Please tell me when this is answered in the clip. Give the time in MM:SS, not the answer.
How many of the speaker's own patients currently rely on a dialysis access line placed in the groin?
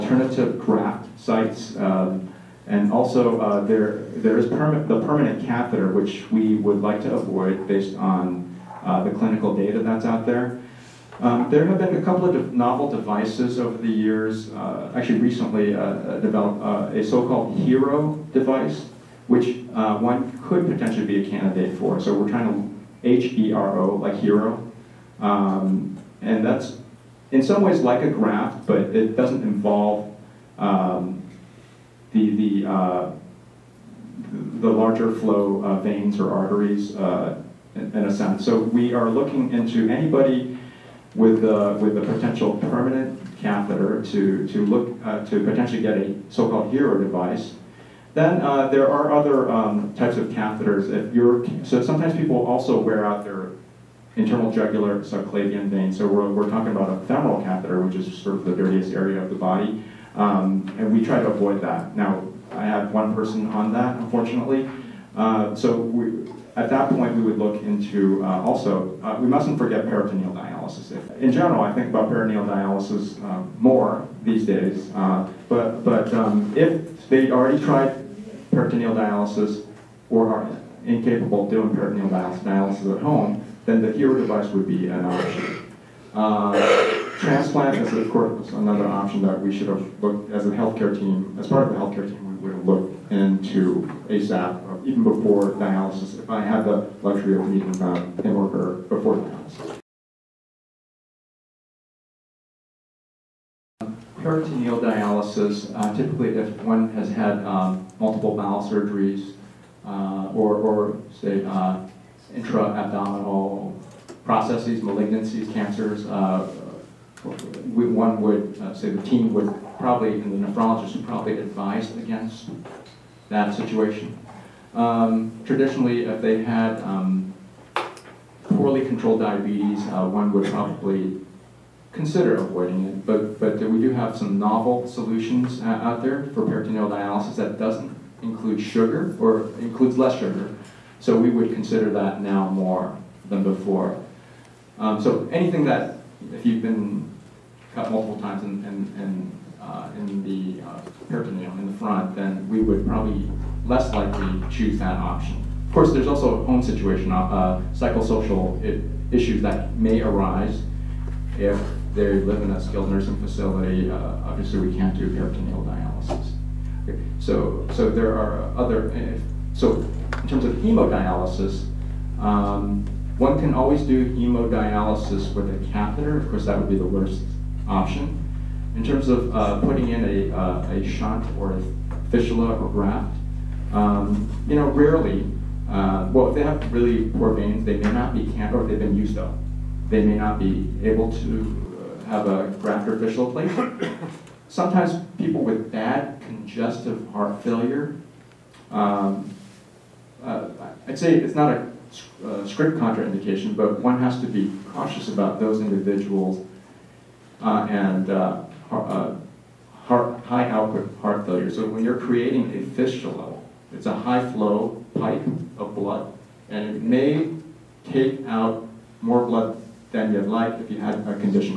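01:02.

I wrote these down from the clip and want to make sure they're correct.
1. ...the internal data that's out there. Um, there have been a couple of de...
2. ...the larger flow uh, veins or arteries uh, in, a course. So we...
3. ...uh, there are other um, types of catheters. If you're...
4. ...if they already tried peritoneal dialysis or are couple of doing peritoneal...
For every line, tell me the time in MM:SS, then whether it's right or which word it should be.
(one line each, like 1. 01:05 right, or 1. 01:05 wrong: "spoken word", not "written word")
1. 00:09 wrong: "clinical", not "internal"
2. 00:34 wrong: "sense", not "course"
3. 00:48 right
4. 01:16 wrong: "incapable", not "couple".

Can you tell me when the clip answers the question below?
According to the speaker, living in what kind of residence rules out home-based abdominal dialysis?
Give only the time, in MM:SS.
02:42.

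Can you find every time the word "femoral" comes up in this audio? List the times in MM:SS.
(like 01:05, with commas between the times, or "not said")
00:57.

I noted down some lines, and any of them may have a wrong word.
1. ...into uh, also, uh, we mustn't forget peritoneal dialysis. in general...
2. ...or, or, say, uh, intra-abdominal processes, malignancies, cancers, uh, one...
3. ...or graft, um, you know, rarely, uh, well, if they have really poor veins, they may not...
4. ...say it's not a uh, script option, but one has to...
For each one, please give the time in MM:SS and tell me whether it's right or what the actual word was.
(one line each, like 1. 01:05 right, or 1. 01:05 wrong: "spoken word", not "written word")
1. 01:07 right
2. 01:50 right
3. 03:02 right
4. 03:20 wrong: "contraindication", not "option".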